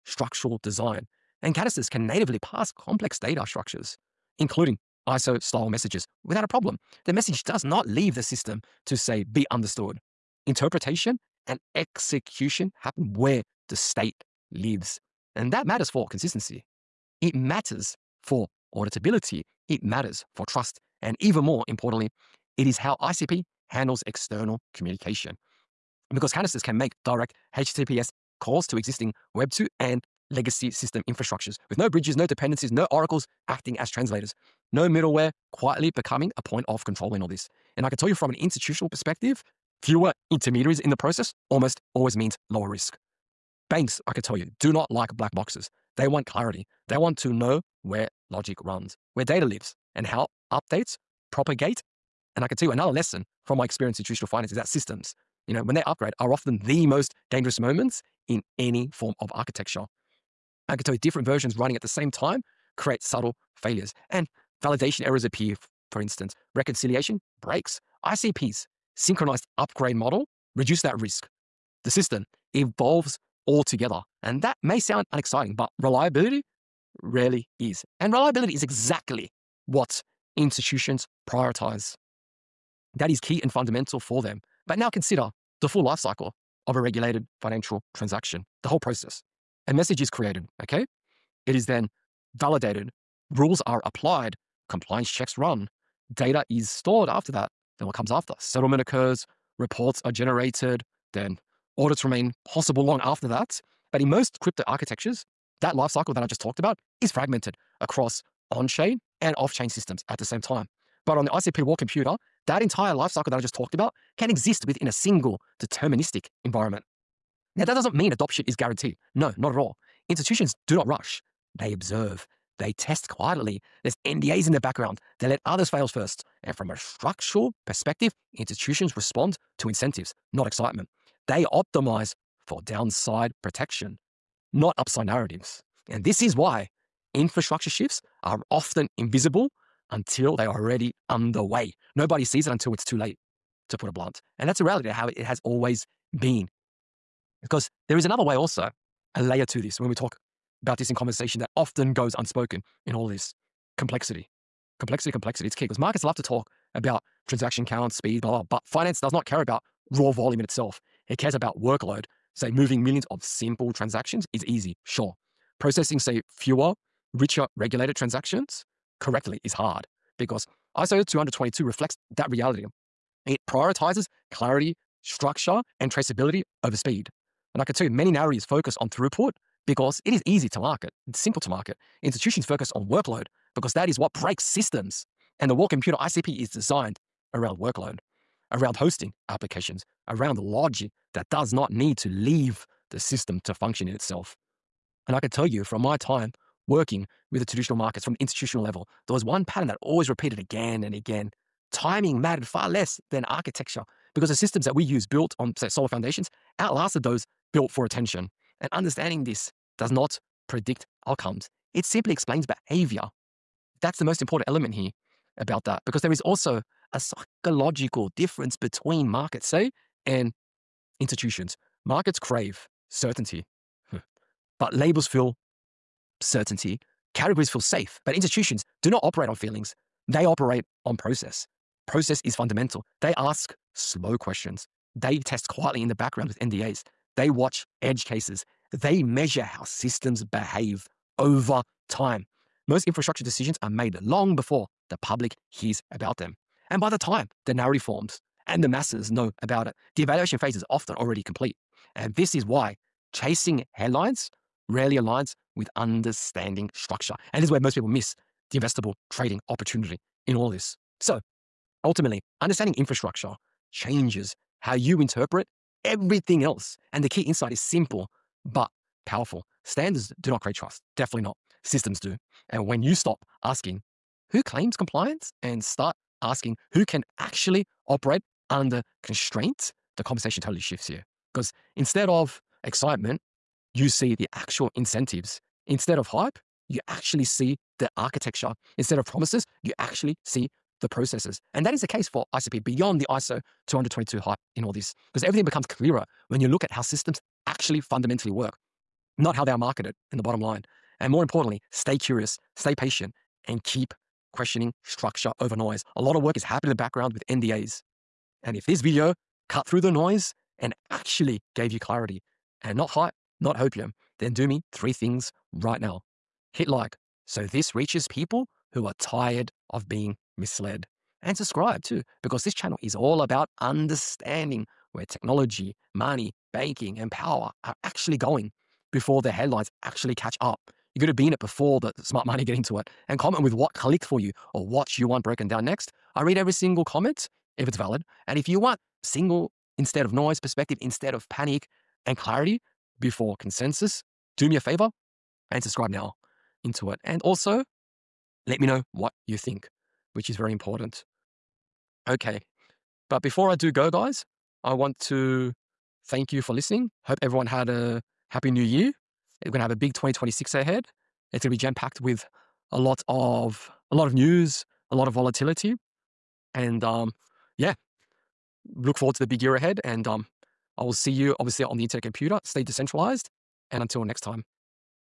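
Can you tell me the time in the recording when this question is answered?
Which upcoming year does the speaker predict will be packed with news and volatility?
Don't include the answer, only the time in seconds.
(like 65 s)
359 s.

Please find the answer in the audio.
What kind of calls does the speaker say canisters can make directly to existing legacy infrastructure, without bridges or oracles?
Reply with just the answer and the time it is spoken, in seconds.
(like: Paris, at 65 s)
HTTPS calls, at 27 s.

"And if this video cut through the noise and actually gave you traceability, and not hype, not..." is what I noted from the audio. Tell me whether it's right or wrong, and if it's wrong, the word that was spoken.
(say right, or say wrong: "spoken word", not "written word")
wrong: "clarity", not "traceability".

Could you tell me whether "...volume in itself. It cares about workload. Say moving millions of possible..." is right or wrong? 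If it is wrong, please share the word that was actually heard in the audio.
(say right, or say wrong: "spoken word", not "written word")
wrong: "simple", not "possible".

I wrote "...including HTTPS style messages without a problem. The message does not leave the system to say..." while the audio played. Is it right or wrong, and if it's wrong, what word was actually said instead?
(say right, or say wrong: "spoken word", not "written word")
wrong: "ISO", not "HTTPS".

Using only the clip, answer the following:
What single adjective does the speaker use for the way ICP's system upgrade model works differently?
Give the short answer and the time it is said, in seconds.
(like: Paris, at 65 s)
Synchronized, at 68 s.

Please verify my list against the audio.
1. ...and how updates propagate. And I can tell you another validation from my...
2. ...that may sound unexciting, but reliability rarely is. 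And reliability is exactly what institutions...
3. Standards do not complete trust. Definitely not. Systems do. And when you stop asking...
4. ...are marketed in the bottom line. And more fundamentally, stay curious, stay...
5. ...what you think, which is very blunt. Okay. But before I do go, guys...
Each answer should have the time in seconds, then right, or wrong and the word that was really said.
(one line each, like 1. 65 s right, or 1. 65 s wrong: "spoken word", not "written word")
1. 49 s wrong: "lesson", not "validation"
2. 74 s right
3. 269 s wrong: "create", not "complete"
4. 299 s wrong: "importantly", not "fundamentally"
5. 348 s wrong: "important", not "blunt".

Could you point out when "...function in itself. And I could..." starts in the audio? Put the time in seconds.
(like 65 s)
193 s.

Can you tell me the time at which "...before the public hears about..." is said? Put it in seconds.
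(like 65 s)
244 s.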